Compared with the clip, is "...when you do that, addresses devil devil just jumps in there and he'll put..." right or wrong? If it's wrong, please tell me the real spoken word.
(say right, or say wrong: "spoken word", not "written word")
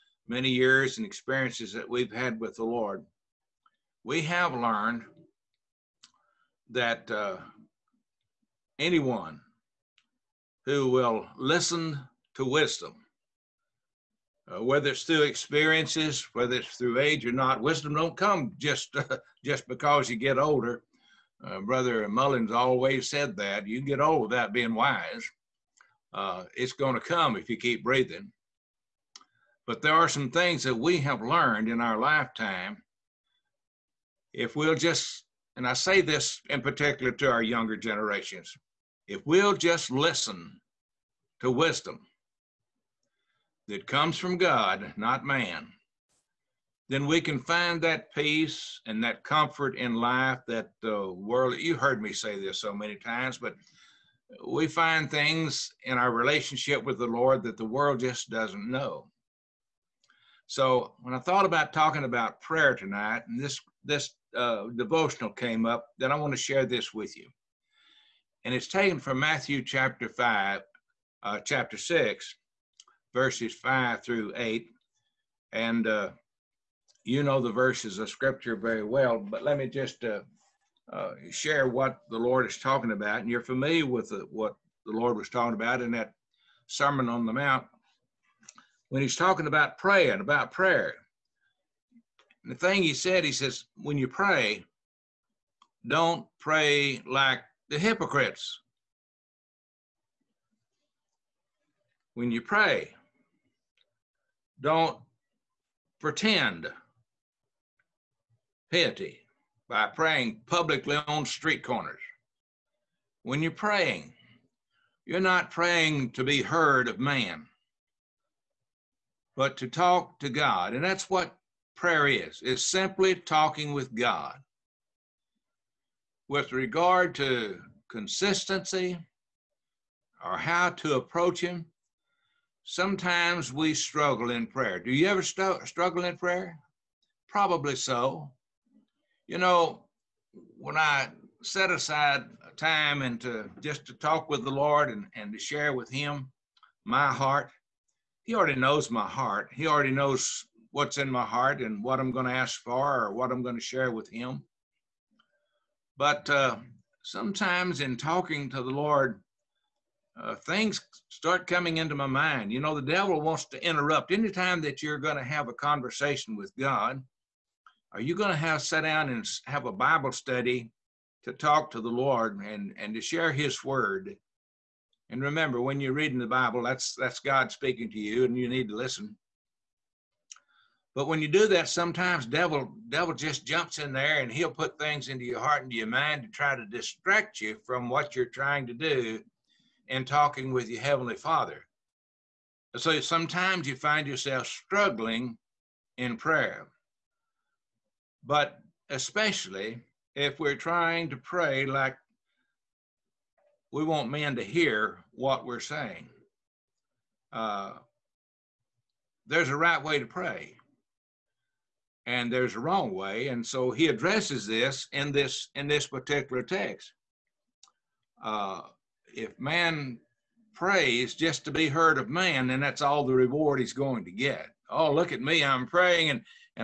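wrong: "sometimes", not "addresses".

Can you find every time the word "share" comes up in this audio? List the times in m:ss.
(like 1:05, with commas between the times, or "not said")
1:06, 1:21, 2:25, 2:33, 2:53.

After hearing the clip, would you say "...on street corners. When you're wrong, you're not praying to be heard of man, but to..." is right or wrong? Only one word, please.
wrong.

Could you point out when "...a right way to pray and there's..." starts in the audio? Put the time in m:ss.
3:29.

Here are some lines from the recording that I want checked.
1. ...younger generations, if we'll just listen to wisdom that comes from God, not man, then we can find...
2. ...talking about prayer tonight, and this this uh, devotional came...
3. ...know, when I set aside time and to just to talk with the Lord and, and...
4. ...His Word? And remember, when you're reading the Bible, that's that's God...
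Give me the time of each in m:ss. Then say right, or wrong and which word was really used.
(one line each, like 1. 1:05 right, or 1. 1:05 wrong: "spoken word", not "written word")
1. 0:37 right
2. 1:01 right
3. 2:19 right
4. 2:53 right.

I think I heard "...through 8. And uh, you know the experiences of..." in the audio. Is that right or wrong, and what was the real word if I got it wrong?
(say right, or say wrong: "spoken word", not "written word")
wrong: "verses", not "experiences".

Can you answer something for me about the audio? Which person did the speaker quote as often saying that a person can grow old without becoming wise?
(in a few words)
Brother Mullins.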